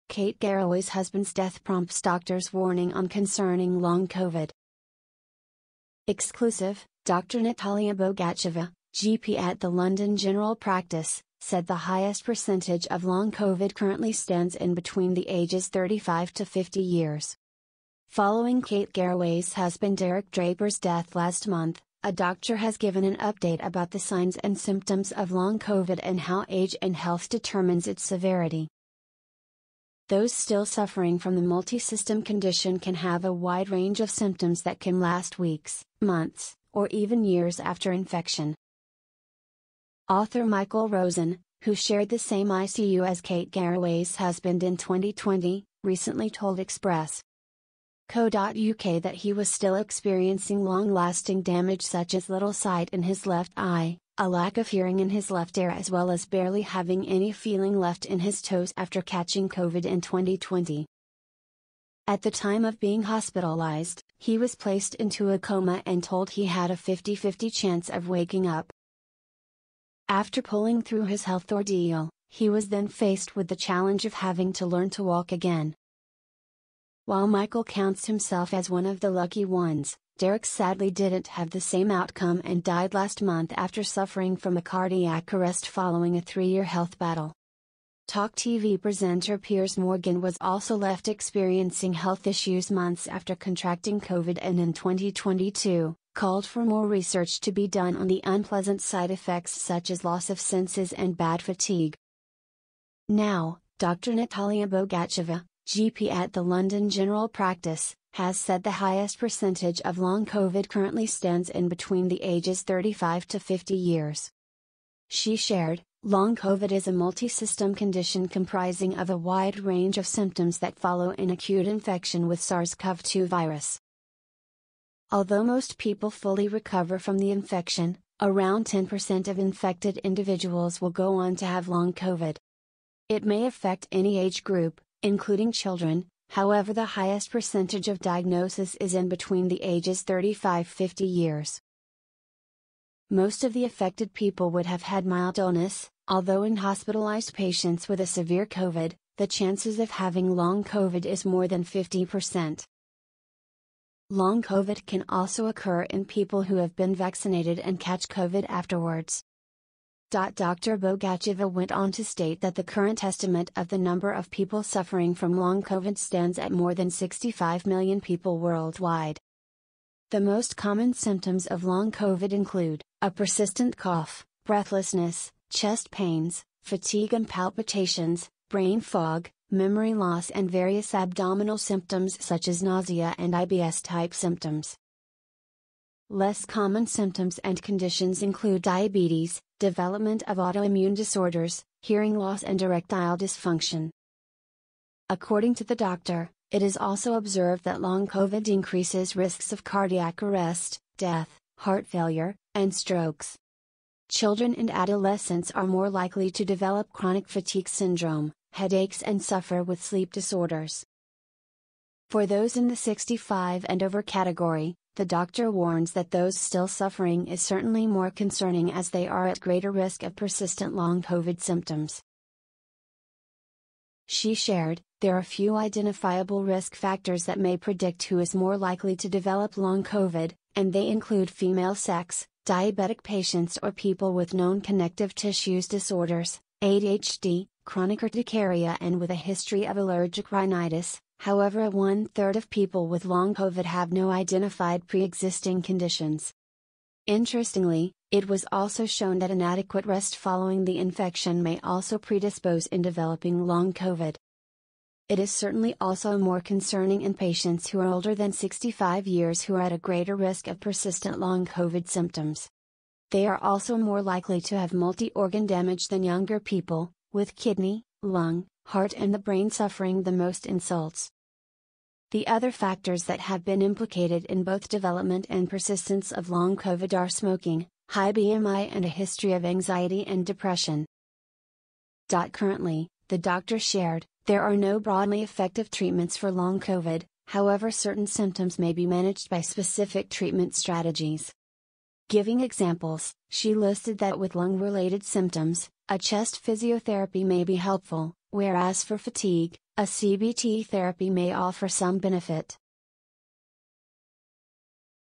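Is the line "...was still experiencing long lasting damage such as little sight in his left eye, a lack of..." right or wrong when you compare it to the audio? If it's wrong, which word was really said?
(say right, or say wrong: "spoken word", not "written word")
right.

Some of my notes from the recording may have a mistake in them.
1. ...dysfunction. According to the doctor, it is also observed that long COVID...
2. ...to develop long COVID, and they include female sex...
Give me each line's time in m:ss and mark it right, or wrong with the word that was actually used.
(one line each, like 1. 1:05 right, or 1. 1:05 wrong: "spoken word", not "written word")
1. 3:13 right
2. 3:48 right.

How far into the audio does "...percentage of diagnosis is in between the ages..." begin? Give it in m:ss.
2:17.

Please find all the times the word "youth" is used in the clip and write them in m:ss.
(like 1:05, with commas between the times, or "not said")
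not said.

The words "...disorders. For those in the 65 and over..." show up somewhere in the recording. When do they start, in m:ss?
3:30.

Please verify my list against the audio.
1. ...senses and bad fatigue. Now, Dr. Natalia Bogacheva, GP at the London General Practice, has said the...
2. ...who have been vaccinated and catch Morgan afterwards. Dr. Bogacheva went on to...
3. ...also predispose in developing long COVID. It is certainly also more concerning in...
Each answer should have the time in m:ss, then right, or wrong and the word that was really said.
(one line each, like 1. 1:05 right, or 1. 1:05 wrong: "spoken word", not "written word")
1. 1:40 right
2. 2:36 wrong: "COVID", not "Morgan"
3. 4:11 right.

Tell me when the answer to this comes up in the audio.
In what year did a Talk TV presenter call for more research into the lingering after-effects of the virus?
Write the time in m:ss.
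1:34.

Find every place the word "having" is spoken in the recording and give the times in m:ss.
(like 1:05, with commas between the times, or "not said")
0:56, 1:14, 2:29.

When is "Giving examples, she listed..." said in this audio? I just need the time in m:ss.
4:52.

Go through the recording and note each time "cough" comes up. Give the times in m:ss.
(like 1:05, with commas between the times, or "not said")
2:53.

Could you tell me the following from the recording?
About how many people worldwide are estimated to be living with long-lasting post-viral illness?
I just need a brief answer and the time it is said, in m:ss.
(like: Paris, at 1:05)
More than 65 million, at 2:46.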